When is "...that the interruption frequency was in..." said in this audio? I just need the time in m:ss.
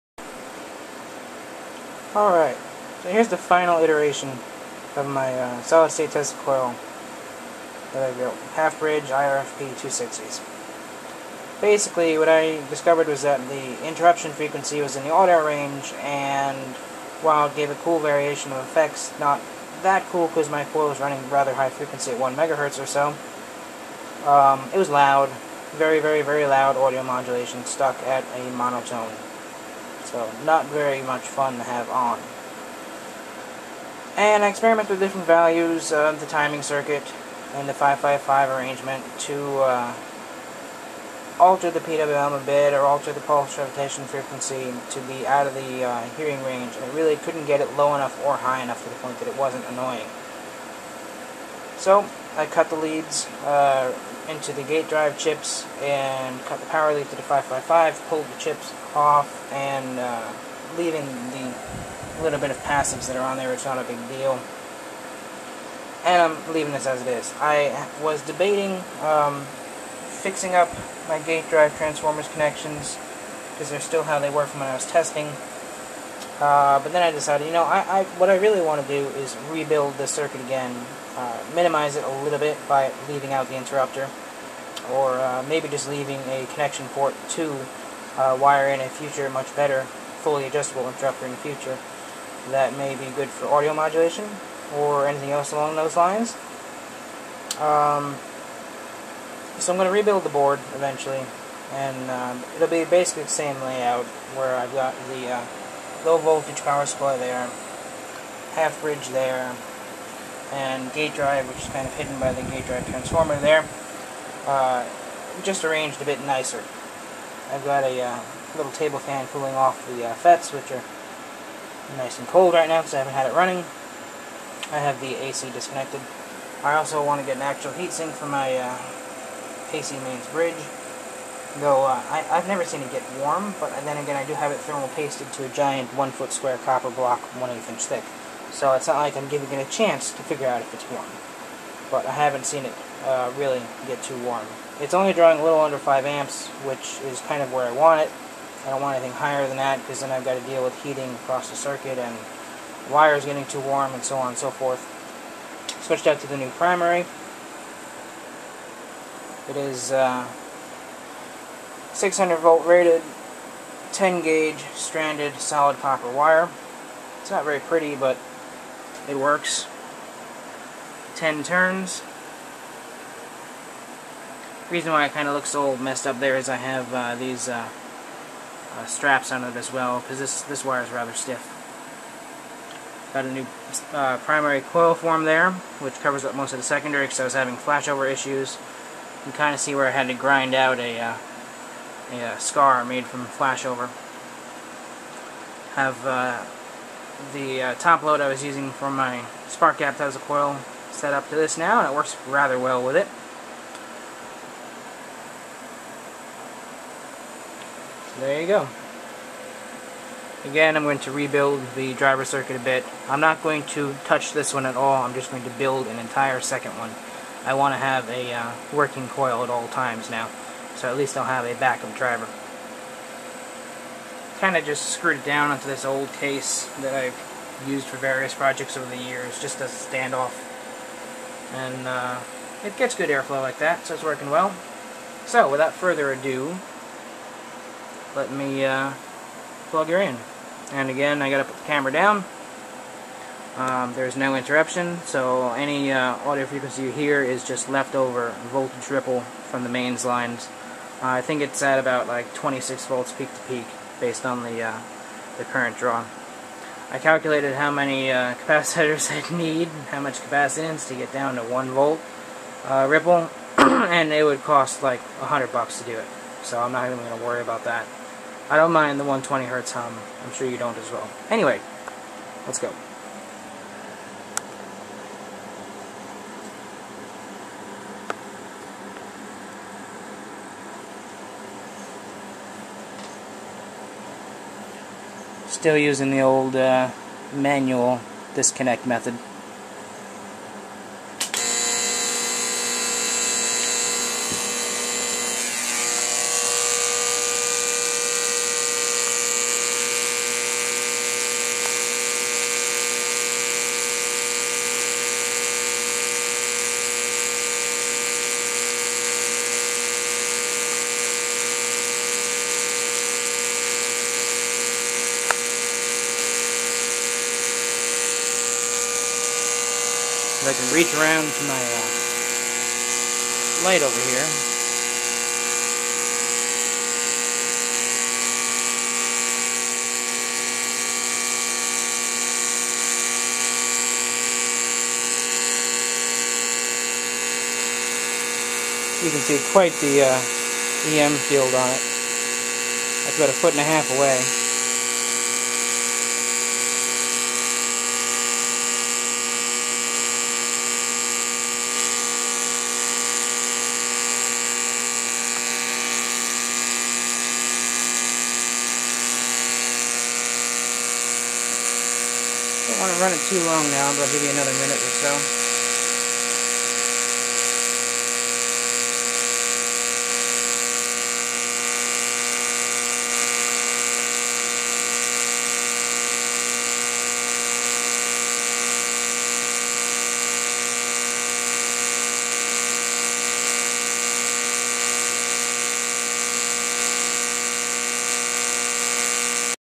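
0:13.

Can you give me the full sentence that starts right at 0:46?
I really couldn't get it low enough or high enough to the point that it wasn't annoying.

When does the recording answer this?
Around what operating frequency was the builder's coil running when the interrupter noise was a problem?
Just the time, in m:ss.
0:22.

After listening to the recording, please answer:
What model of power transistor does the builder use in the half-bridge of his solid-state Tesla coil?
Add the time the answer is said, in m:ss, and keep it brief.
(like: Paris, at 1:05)
IRFP 260, at 0:09.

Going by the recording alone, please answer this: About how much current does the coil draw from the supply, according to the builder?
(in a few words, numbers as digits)
under 5 amps.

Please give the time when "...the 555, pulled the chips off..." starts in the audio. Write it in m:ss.
0:57.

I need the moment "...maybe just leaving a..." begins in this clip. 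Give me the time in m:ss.
1:25.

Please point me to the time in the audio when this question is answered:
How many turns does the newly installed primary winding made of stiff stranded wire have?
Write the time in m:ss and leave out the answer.
2:51.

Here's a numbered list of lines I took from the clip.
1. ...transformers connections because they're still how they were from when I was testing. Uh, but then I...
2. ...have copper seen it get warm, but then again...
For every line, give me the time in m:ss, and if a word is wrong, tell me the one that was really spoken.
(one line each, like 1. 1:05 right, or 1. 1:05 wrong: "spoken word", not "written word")
1. 1:11 right
2. 2:12 wrong: "never", not "copper".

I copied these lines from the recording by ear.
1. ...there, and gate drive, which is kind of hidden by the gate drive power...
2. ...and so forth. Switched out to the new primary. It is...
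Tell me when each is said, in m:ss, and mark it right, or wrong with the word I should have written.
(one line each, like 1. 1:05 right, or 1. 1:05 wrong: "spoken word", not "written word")
1. 1:49 wrong: "transformer", not "power"
2. 2:34 right.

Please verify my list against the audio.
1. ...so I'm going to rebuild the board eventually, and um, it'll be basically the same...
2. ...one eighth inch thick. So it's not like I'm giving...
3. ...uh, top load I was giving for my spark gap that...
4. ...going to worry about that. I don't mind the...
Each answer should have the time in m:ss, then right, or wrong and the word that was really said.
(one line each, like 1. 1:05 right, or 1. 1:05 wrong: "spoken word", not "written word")
1. 1:39 right
2. 2:17 right
3. 3:17 wrong: "using", not "giving"
4. 4:26 right.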